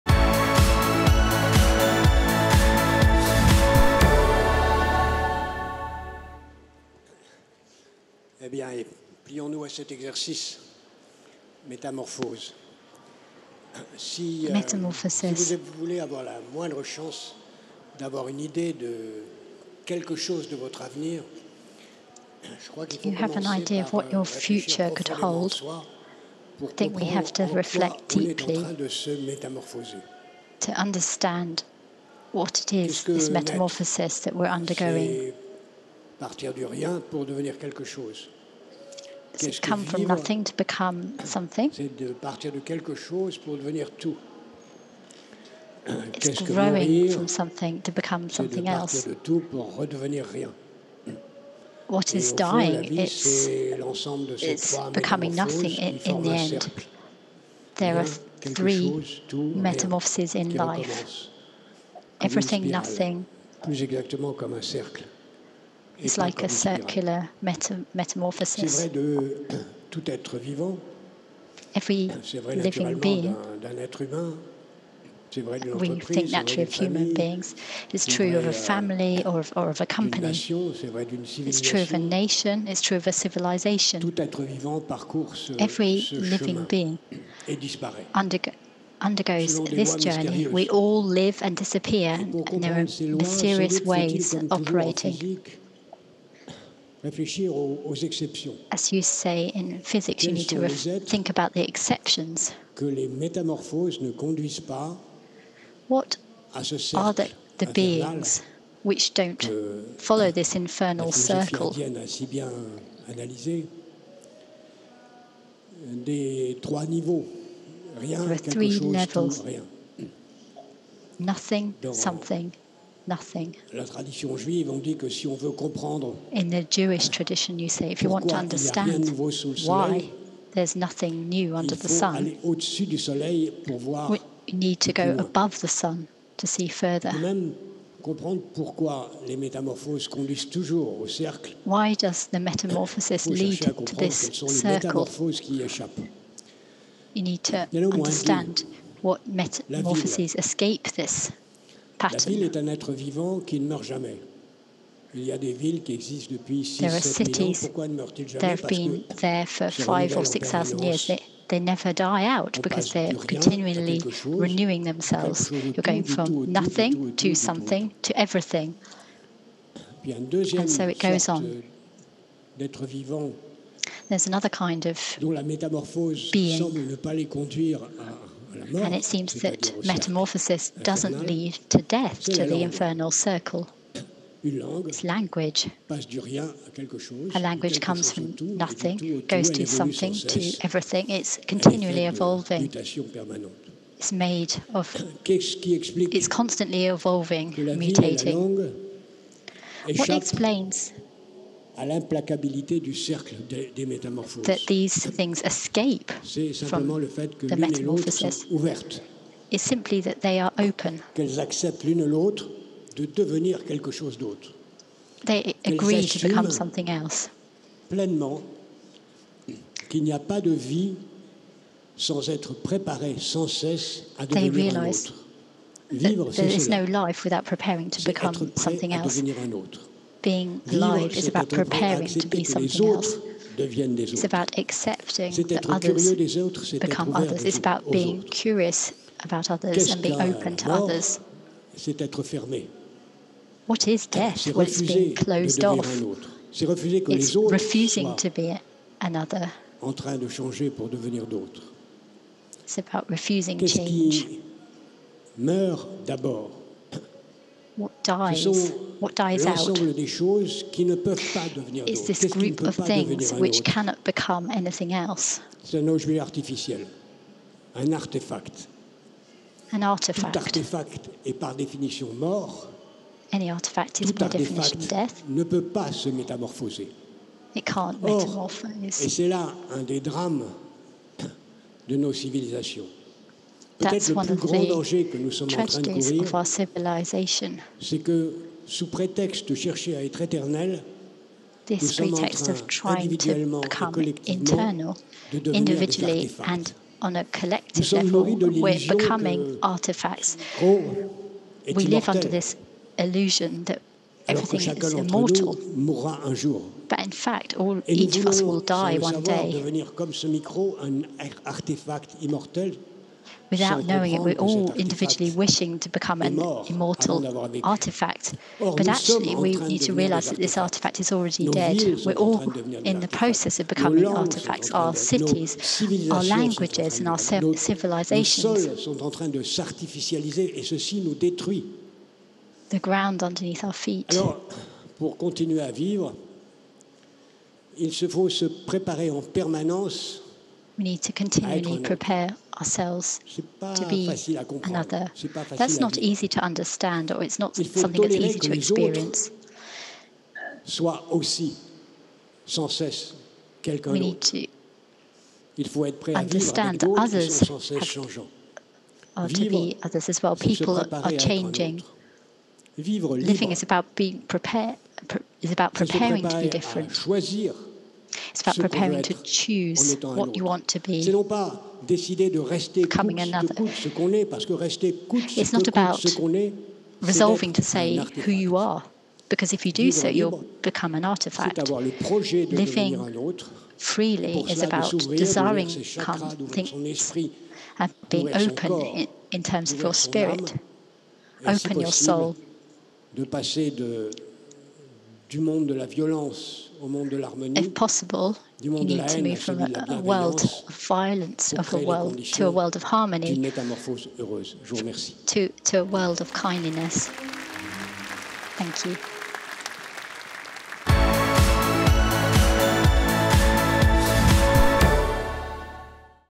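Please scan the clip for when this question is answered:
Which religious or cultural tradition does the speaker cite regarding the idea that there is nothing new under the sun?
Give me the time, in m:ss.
2:06.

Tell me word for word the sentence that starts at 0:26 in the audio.
I think we have to reflect deeply to understand what it is, this metamorphosis that we're undergoing.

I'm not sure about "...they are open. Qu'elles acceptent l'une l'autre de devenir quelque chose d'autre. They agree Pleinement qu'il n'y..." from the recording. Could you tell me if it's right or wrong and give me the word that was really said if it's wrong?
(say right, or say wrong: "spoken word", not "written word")
right.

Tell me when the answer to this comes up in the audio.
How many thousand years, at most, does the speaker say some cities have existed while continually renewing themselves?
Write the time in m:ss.
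2:40.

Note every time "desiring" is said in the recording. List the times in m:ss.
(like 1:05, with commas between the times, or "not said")
6:24.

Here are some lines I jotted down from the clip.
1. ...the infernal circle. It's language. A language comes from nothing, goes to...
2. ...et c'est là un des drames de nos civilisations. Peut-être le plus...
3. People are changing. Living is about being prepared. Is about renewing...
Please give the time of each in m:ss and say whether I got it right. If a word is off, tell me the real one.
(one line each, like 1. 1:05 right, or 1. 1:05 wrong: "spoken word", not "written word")
1. 3:02 right
2. 4:38 right
3. 6:00 wrong: "preparing", not "renewing".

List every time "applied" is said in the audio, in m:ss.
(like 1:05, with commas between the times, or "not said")
not said.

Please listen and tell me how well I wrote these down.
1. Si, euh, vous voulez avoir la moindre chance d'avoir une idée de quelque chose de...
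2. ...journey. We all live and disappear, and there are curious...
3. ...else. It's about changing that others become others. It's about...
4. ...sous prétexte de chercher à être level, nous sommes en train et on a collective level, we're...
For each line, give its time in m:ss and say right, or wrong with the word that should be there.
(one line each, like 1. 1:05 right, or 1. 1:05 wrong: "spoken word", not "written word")
1. 0:13 right
2. 1:29 wrong: "mysterious", not "curious"
3. 3:52 wrong: "accepting", not "changing"
4. 4:48 wrong: "éternel", not "level".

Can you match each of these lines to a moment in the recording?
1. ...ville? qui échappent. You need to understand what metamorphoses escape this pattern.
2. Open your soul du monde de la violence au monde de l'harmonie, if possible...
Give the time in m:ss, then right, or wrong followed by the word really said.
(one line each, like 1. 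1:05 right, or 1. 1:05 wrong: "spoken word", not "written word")
1. 2:24 wrong: "circle", not "ville"
2. 6:31 right.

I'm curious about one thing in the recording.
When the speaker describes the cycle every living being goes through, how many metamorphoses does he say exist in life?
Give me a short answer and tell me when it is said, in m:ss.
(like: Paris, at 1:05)
3, at 0:58.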